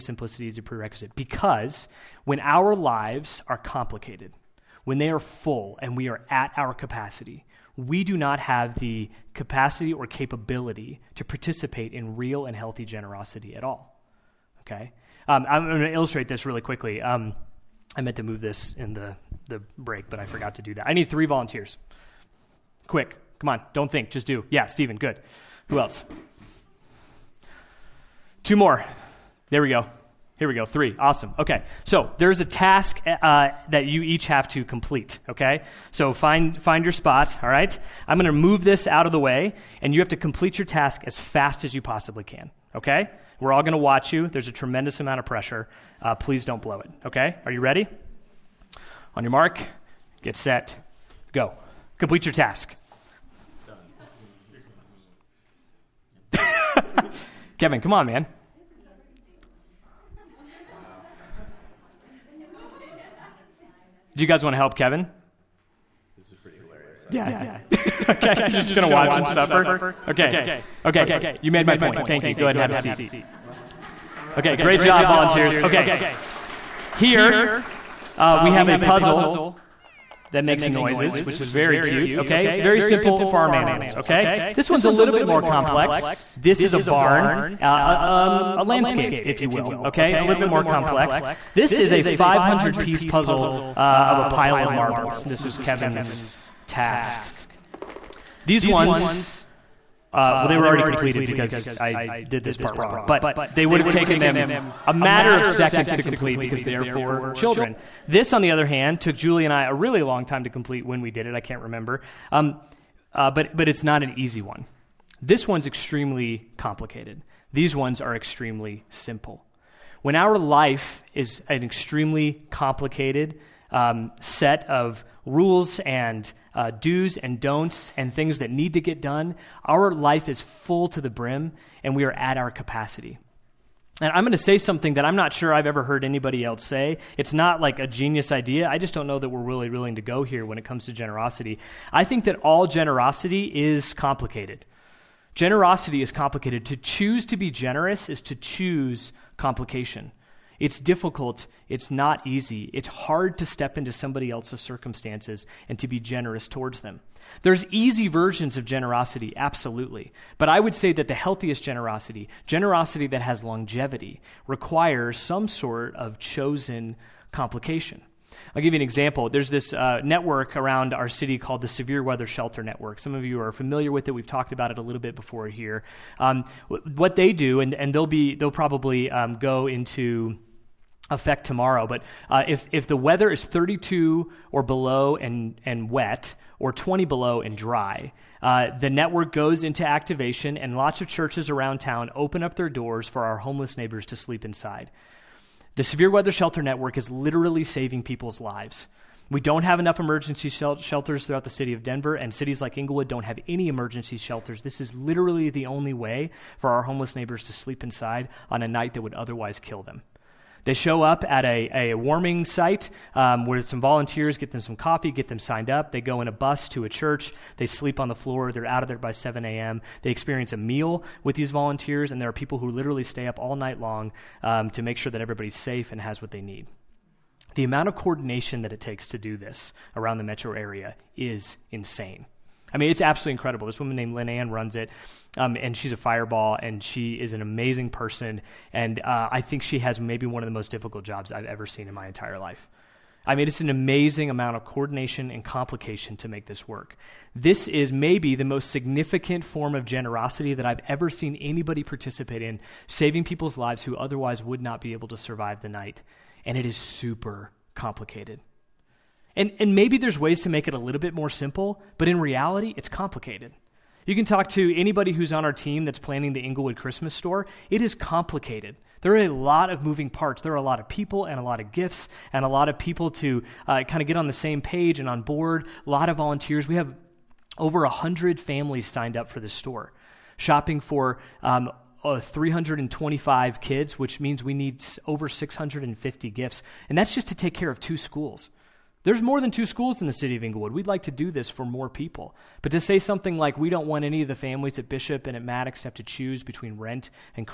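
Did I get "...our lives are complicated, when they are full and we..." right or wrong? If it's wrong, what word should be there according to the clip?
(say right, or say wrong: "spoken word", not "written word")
right.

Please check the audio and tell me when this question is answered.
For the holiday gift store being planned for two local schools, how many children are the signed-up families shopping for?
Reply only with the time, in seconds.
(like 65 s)
282 s.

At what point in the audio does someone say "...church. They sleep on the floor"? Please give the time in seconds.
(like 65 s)
216 s.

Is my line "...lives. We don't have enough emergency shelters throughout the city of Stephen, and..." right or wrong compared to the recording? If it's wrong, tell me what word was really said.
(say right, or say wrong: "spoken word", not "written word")
wrong: "Denver", not "Stephen".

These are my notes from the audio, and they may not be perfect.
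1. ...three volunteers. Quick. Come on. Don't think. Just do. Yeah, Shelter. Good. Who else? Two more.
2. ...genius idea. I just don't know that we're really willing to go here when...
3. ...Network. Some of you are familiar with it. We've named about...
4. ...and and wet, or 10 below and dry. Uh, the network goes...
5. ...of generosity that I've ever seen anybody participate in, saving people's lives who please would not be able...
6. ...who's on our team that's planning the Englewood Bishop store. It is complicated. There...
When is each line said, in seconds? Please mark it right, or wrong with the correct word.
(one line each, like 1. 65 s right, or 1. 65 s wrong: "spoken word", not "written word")
1. 21 s wrong: "Stephen", not "Shelter"
2. 137 s right
3. 172 s wrong: "talked", not "named"
4. 185 s wrong: "20", not "10"
5. 249 s wrong: "otherwise", not "please"
6. 265 s wrong: "Christmas", not "Bishop".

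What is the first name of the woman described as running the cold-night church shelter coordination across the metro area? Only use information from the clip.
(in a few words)
Lynn Ann.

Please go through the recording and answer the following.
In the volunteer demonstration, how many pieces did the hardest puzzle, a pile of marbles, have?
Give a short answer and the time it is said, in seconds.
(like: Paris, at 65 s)
500, at 92 s.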